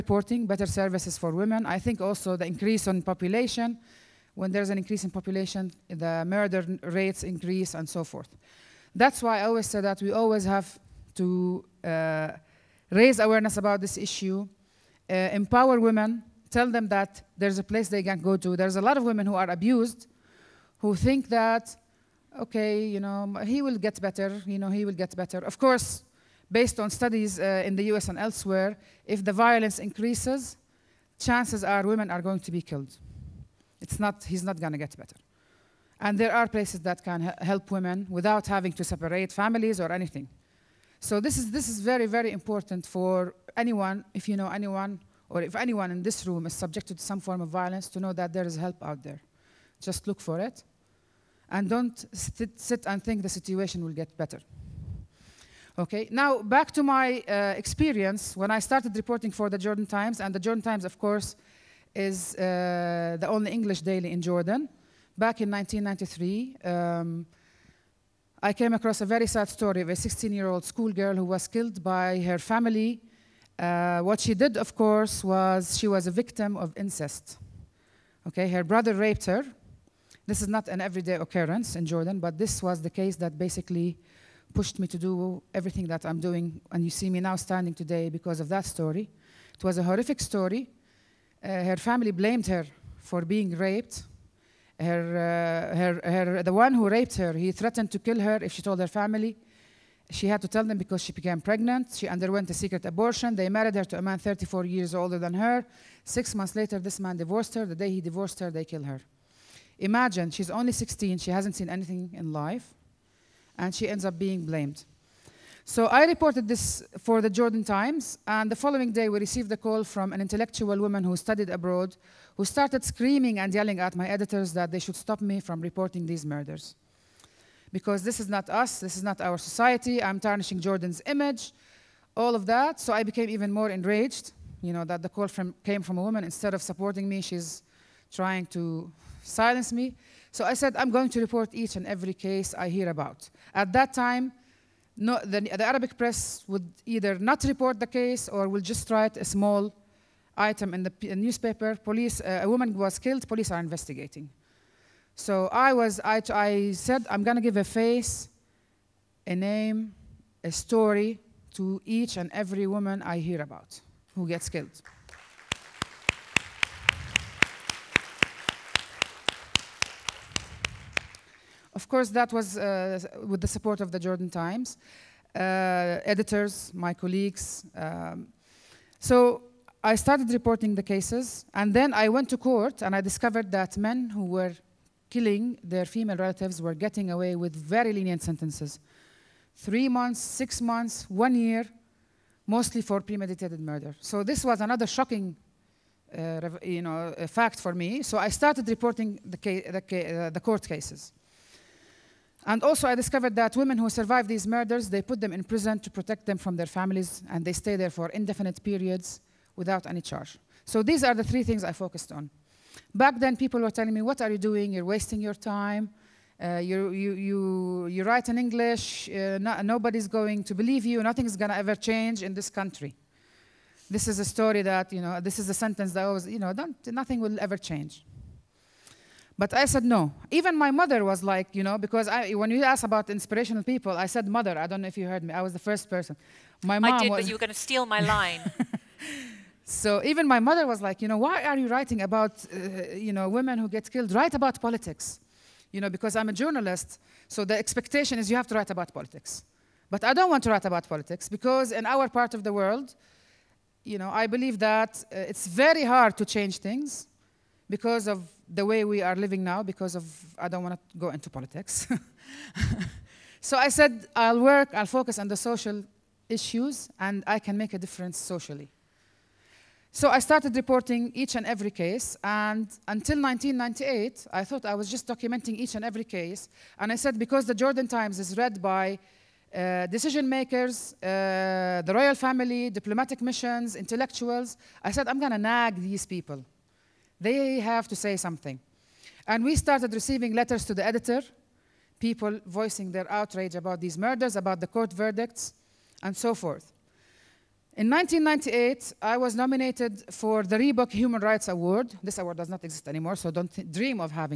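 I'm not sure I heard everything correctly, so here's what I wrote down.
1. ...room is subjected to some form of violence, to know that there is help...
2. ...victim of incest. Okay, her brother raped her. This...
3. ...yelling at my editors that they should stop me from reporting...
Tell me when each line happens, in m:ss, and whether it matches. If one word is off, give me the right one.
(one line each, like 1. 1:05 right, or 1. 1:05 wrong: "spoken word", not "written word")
1. 0:46 right
2. 1:16 right
3. 2:03 right.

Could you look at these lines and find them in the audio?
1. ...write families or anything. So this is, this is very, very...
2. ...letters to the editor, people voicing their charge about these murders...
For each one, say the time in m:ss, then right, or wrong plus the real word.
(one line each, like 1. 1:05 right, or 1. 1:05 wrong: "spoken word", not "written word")
1. 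0:38 wrong: "separate", not "write"
2. 4:50 wrong: "outrage", not "charge".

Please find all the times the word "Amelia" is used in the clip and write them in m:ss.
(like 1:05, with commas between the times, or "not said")
not said.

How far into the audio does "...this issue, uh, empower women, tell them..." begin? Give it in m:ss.
0:13.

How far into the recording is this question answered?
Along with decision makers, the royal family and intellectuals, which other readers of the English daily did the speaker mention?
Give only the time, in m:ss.
4:42.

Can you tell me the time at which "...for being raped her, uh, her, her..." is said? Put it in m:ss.
1:33.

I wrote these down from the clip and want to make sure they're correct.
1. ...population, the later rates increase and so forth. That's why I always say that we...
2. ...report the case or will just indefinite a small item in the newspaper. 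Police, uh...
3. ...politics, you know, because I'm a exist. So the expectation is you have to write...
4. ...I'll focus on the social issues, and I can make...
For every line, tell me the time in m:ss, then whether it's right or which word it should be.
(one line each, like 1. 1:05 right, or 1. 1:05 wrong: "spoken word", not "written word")
1. 0:05 wrong: "murder", not "later"
2. 2:27 wrong: "write", not "indefinite"
3. 4:04 wrong: "journalist", not "exist"
4. 4:24 right.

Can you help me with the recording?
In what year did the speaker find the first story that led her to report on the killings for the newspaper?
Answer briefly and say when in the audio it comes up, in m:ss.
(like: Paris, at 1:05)
1993, at 1:05.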